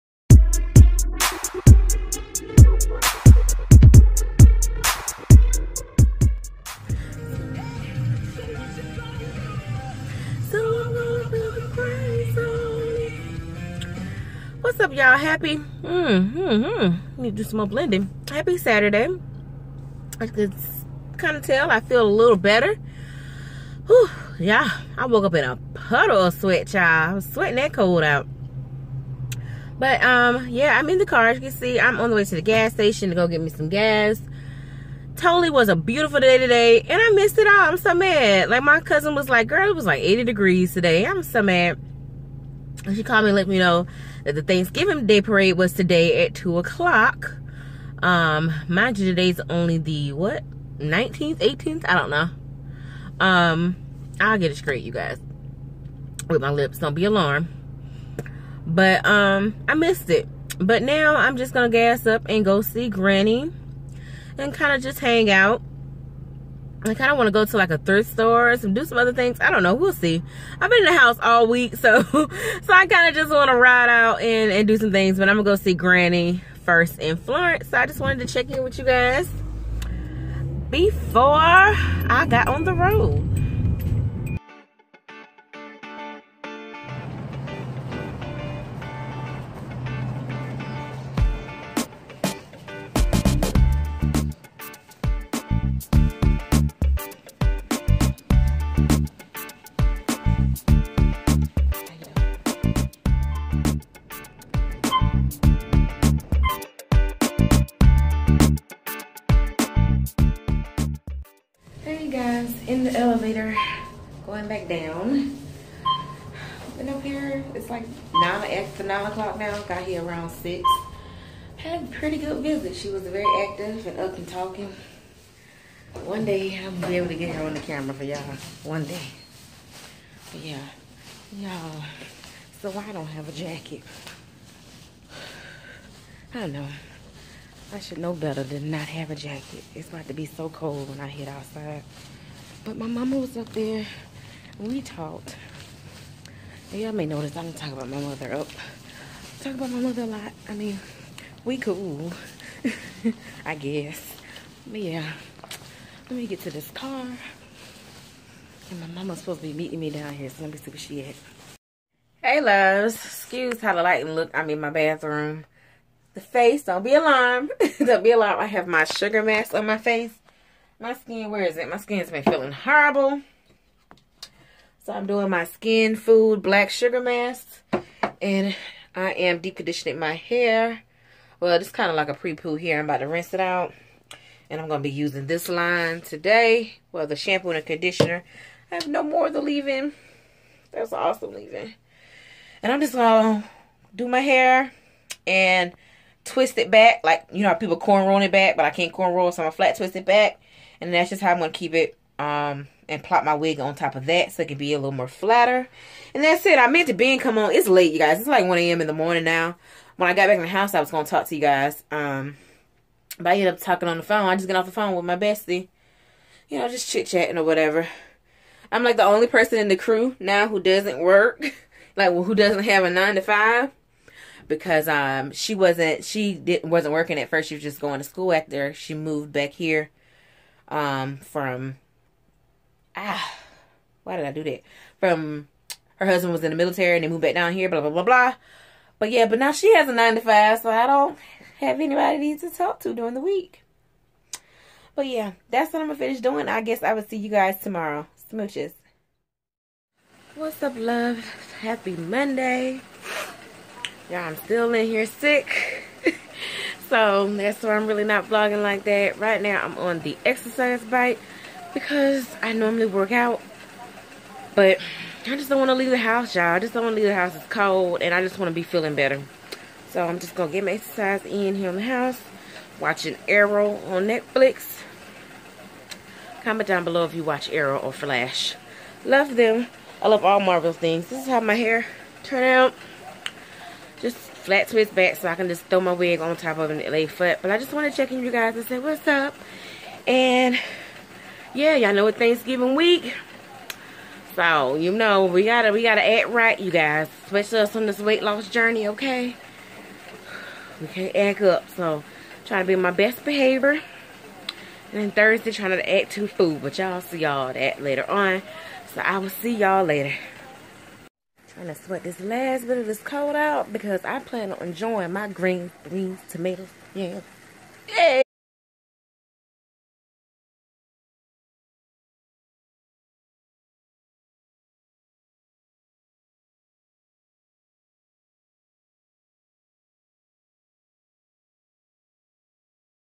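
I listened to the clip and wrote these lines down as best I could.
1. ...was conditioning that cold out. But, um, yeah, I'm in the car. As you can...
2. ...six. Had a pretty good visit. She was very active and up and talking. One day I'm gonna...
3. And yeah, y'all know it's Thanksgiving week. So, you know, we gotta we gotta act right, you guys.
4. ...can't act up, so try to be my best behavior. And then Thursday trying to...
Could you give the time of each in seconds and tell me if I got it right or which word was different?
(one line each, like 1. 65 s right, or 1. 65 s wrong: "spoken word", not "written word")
1. 27 s wrong: "sweating", not "conditioning"
2. 120 s right
3. 290 s right
4. 300 s right.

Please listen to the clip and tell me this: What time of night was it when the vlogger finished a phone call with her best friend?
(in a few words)
1 a.m.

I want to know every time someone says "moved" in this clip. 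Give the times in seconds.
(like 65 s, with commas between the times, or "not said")
228 s, 237 s.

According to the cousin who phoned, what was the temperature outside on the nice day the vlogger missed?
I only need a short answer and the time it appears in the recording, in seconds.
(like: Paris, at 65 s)
80 degrees, at 40 s.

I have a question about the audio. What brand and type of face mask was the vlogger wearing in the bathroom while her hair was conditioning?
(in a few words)
Skin food black sugar mask.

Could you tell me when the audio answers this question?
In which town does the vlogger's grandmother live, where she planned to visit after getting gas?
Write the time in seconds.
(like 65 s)
77 s.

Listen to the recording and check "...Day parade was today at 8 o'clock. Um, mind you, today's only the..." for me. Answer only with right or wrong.
wrong.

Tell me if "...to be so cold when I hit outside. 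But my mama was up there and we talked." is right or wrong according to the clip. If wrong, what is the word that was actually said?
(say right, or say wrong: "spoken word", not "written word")
right.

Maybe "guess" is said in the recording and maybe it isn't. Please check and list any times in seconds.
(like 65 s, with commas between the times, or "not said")
153 s, 246 s.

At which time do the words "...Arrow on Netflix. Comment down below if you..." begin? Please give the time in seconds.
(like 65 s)
273 s.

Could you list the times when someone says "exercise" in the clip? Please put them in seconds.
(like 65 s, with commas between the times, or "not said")
260 s, 270 s.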